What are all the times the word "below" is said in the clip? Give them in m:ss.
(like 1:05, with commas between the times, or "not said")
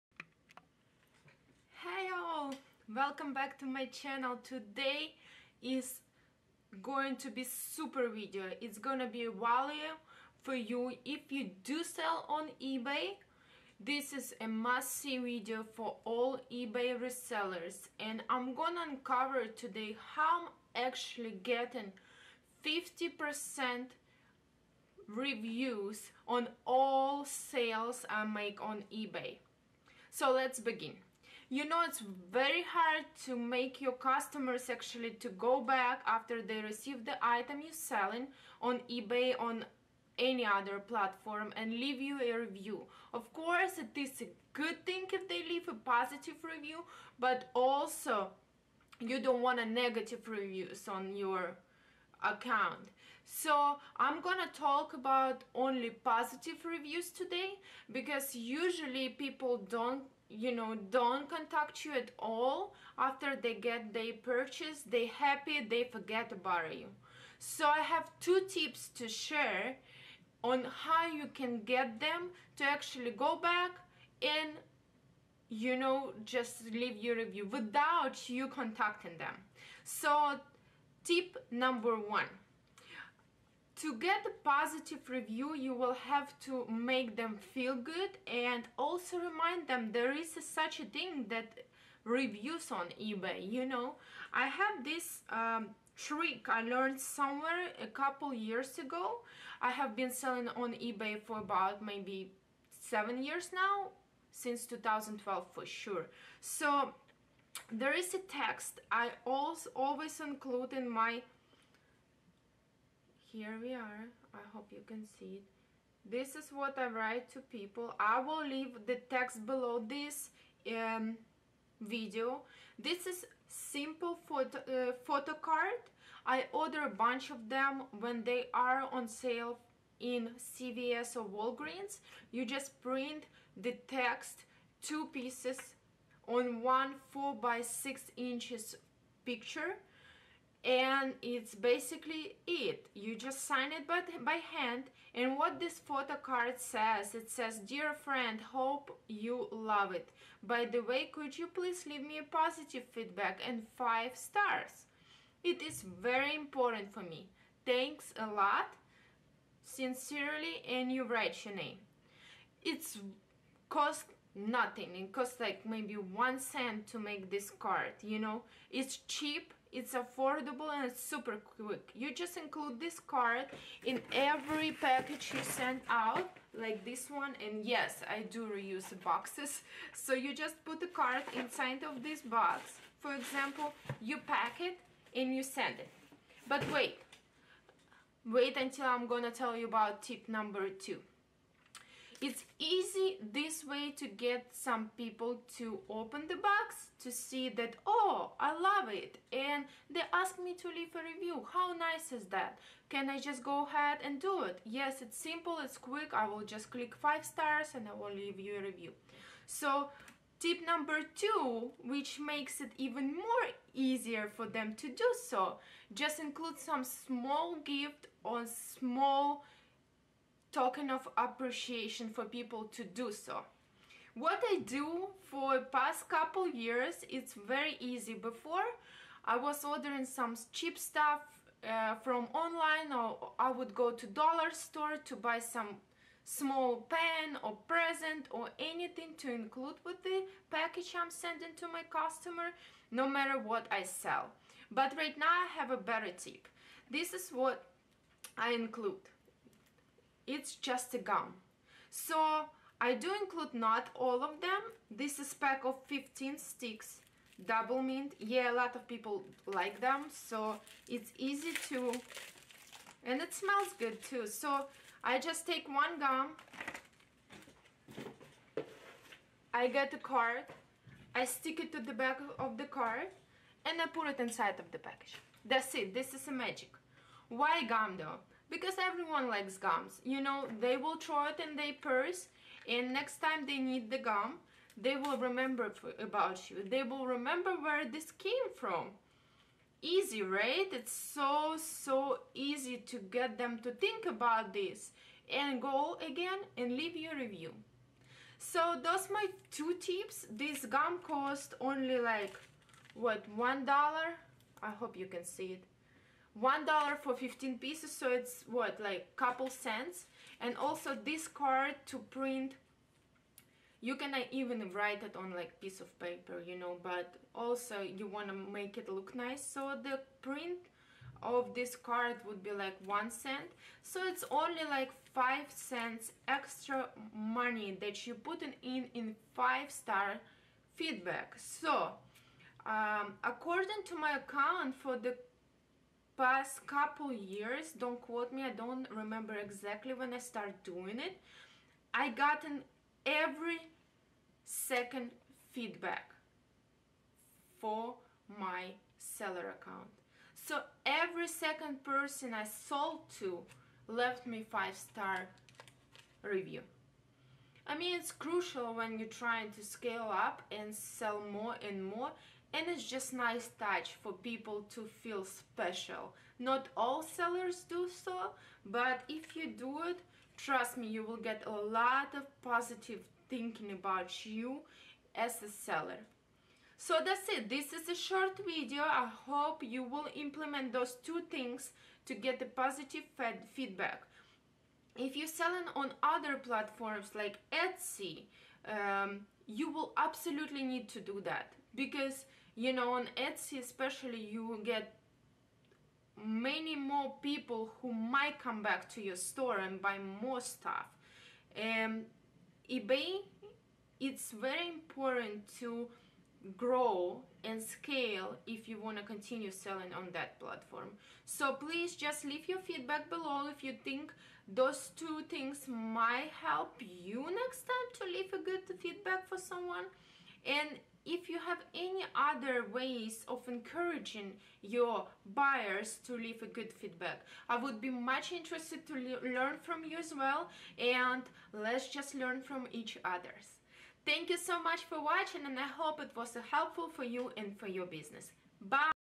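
1:59, 6:53.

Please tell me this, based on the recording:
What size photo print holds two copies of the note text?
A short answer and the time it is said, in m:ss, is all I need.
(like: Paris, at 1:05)
4 by 6 inches, at 2:17.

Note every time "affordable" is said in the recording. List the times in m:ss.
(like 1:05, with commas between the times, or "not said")
2:49.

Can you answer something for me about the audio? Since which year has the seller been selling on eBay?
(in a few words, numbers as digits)
2012.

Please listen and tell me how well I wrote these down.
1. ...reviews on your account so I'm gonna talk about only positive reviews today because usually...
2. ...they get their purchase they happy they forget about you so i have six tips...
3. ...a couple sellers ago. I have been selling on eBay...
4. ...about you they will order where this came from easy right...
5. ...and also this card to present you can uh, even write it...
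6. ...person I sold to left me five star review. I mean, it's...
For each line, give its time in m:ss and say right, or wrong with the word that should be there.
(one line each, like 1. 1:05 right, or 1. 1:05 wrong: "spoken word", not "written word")
1. 0:50 right
2. 1:03 wrong: "two", not "six"
3. 1:37 wrong: "years", not "sellers"
4. 4:45 wrong: "remember", not "order"
5. 5:10 wrong: "print", not "present"
6. 5:51 right.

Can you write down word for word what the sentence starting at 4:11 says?
So I do include not all of them.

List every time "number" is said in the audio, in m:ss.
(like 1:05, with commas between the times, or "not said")
1:21, 3:10, 3:30.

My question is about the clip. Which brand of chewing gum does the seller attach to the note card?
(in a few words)
Doublemint.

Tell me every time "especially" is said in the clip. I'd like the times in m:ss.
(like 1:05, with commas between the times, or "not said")
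6:33.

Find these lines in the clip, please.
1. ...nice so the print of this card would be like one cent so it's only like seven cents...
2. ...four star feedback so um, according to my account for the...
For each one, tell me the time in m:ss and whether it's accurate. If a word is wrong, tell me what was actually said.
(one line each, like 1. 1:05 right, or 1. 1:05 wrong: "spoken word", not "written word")
1. 5:19 wrong: "five", not "seven"
2. 5:29 wrong: "five", not "four".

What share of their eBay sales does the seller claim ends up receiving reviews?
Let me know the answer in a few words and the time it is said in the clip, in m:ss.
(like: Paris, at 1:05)
50 percent, at 0:22.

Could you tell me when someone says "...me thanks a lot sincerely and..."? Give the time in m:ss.
2:37.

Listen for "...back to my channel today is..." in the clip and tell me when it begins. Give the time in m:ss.
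0:03.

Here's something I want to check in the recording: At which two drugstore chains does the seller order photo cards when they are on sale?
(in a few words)
CVS or Walgreens.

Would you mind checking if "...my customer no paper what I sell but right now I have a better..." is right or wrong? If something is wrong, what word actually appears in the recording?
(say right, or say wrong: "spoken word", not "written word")
wrong: "matter", not "paper".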